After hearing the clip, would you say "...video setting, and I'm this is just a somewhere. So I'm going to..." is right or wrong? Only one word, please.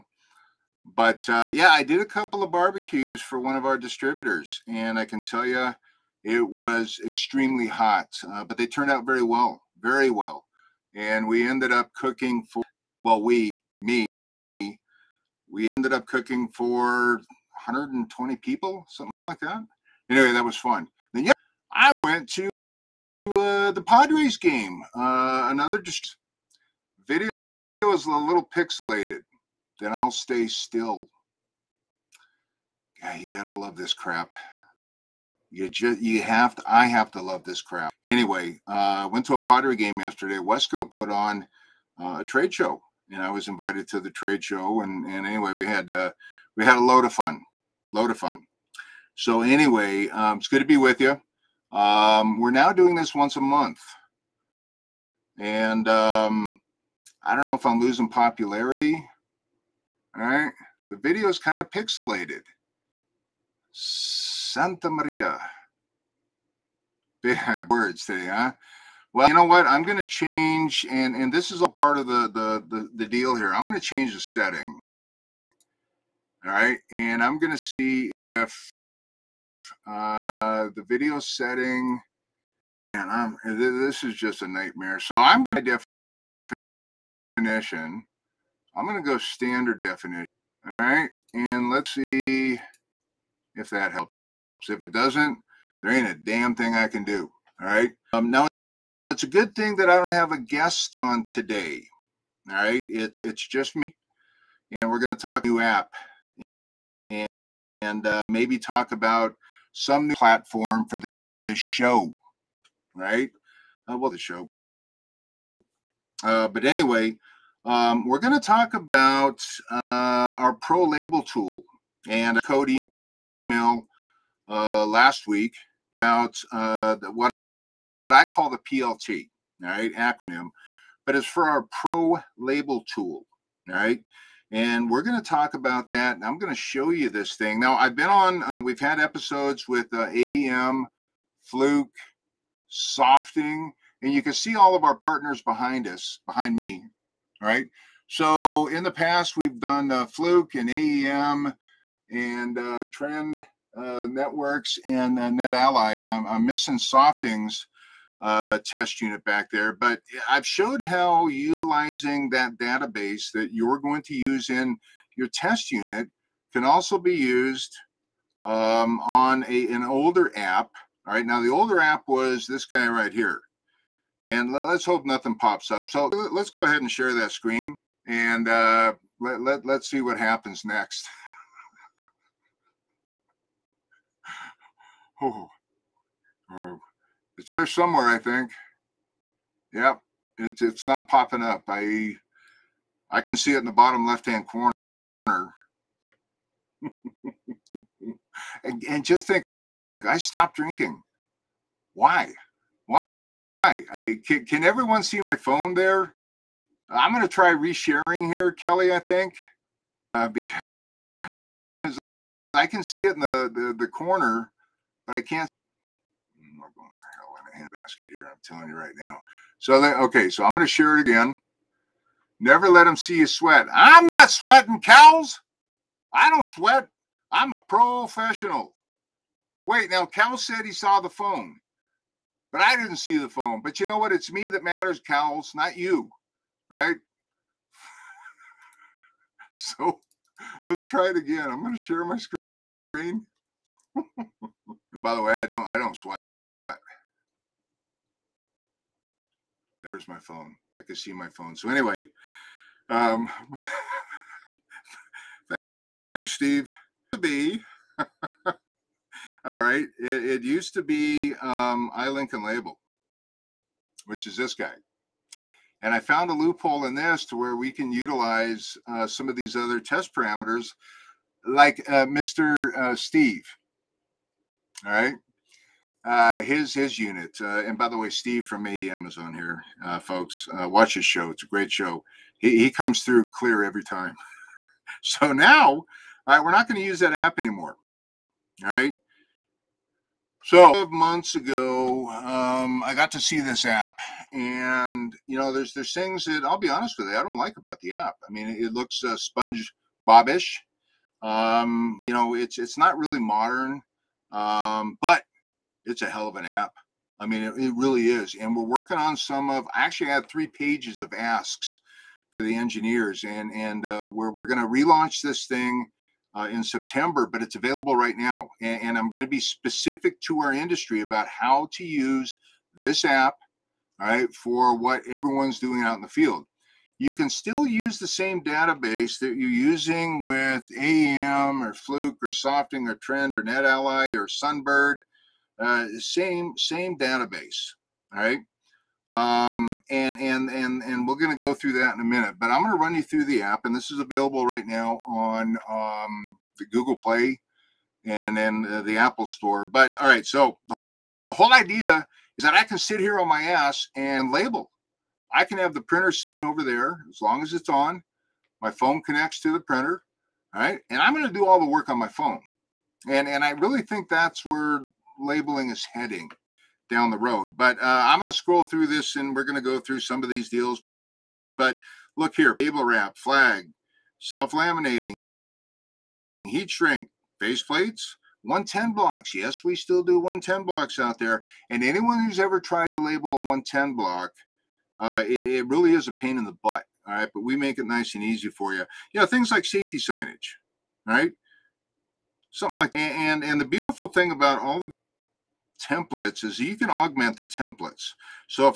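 wrong.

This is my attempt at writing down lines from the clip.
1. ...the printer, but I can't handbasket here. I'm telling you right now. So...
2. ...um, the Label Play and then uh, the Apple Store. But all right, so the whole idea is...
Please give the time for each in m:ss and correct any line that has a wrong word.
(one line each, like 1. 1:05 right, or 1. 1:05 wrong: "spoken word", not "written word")
1. 3:33 wrong: "corner", not "printer"
2. 5:45 wrong: "Google", not "Label".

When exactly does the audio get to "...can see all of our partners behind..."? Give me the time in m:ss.
2:24.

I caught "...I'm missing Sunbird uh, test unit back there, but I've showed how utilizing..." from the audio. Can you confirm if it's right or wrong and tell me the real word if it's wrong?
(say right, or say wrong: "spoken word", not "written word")
wrong: "Softings", not "Sunbird".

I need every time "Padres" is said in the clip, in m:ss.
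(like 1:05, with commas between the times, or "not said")
0:23, 0:39.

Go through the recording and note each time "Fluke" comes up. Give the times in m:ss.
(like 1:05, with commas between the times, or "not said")
2:21, 2:30, 5:31.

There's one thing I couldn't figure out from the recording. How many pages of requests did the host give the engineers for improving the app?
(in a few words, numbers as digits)
3.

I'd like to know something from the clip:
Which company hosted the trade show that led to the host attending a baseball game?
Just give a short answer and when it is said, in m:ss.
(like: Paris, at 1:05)
Wesco, at 0:40.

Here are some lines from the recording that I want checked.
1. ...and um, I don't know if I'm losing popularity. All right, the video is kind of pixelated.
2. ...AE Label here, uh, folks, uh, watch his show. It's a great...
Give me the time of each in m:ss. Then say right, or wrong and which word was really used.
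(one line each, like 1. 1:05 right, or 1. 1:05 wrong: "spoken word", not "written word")
1. 0:55 right
2. 4:38 wrong: "Amazon", not "Label".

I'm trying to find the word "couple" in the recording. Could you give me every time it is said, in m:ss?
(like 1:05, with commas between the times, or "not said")
0:02.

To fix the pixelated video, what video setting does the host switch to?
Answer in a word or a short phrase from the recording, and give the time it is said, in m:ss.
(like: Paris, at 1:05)
Standard definition, at 1:29.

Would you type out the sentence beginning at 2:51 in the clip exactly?
All right, now the older app was this guy right here.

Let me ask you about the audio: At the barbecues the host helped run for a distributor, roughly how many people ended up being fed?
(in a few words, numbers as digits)
120.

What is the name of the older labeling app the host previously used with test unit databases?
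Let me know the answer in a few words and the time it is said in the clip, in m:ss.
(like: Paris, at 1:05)
Lincoln Label, at 4:22.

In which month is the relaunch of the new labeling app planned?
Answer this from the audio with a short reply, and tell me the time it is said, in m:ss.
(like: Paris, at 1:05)
September, at 5:16.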